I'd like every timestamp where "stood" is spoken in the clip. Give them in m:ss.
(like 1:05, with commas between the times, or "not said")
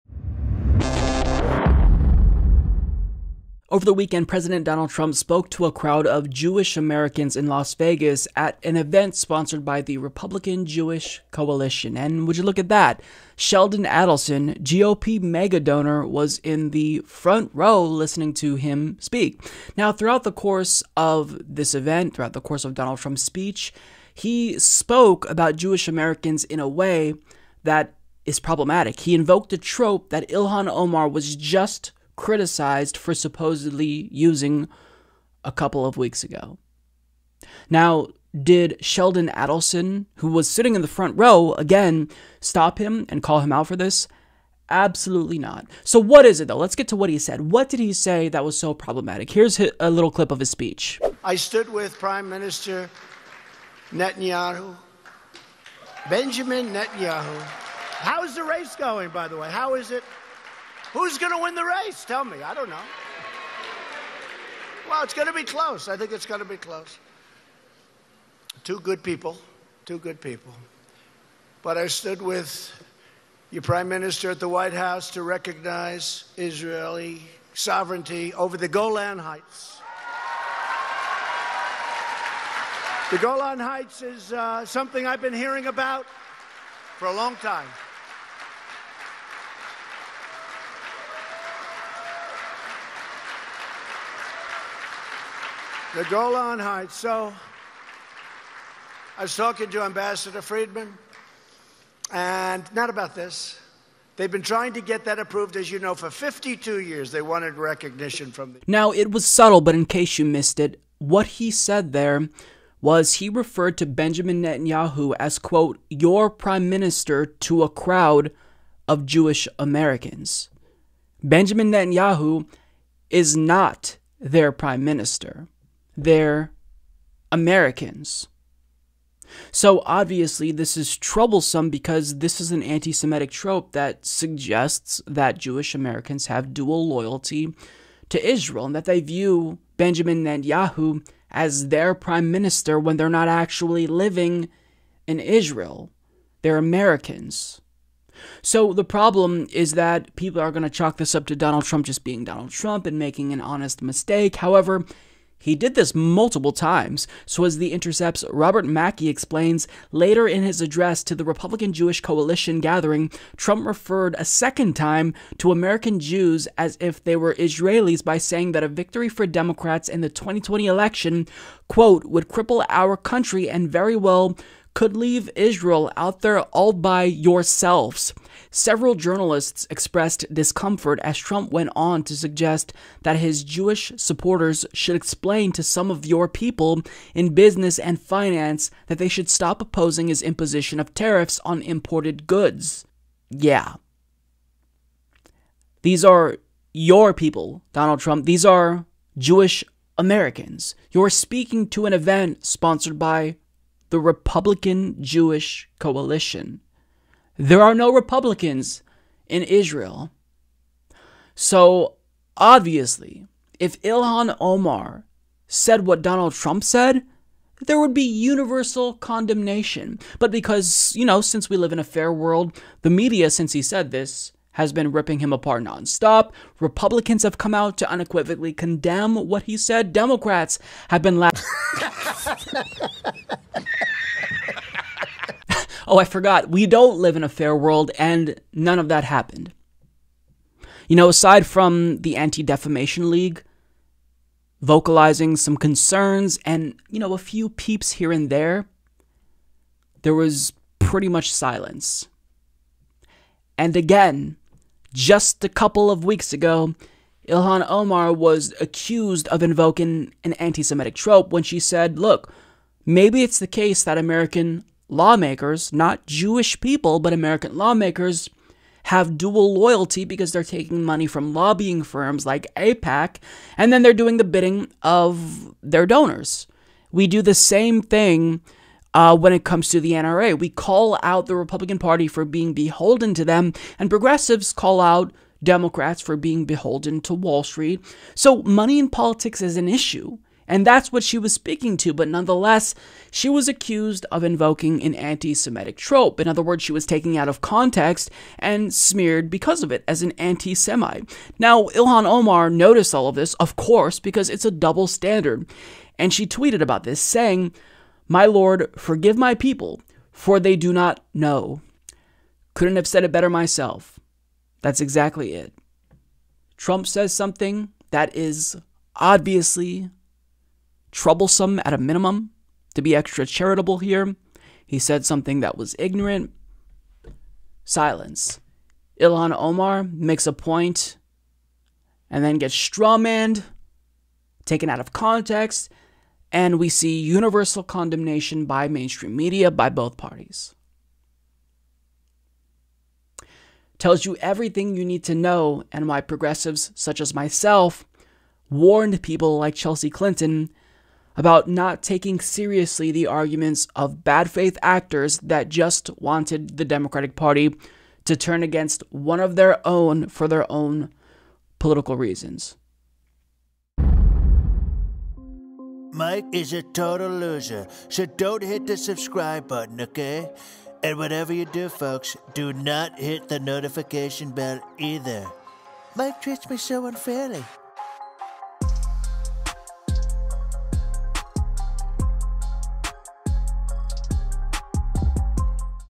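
0:51, 1:11.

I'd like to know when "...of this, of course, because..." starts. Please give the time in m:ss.
5:03.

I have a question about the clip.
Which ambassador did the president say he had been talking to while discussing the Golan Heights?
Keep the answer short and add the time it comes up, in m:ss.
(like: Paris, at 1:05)
Ambassador Friedman, at 1:39.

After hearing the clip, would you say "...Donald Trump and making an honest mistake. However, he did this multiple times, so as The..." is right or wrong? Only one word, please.
right.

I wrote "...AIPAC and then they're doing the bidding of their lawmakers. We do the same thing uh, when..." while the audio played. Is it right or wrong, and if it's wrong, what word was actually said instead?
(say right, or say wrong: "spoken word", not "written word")
wrong: "donors", not "lawmakers".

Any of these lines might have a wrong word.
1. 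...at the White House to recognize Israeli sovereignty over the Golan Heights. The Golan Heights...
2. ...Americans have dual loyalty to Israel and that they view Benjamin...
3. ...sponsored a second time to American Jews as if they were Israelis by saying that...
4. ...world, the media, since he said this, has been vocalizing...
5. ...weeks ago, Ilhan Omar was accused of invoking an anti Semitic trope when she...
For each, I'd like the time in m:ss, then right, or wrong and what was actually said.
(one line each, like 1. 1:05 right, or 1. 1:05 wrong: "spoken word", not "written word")
1. 1:14 right
2. 2:15 right
3. 2:43 wrong: "referred", not "sponsored"
4. 3:42 wrong: "ripping", not "vocalizing"
5. 4:16 right.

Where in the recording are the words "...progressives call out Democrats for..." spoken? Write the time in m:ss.
4:43.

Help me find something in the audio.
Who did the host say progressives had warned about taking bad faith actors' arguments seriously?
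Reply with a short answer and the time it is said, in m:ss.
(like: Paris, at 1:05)
Chelsea Clinton, at 5:49.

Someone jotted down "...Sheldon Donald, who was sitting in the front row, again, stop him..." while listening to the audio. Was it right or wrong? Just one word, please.
wrong.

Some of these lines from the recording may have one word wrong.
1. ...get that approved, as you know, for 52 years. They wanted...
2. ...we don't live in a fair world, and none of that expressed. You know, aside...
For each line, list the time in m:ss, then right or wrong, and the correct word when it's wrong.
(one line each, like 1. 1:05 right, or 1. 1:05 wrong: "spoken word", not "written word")
1. 1:44 right
2. 3:56 wrong: "happened", not "expressed".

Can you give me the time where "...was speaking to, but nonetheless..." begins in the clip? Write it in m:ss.
4:51.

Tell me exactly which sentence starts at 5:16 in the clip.
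Trump says something that is obviously troublesome at a minimum to be extra charitable here.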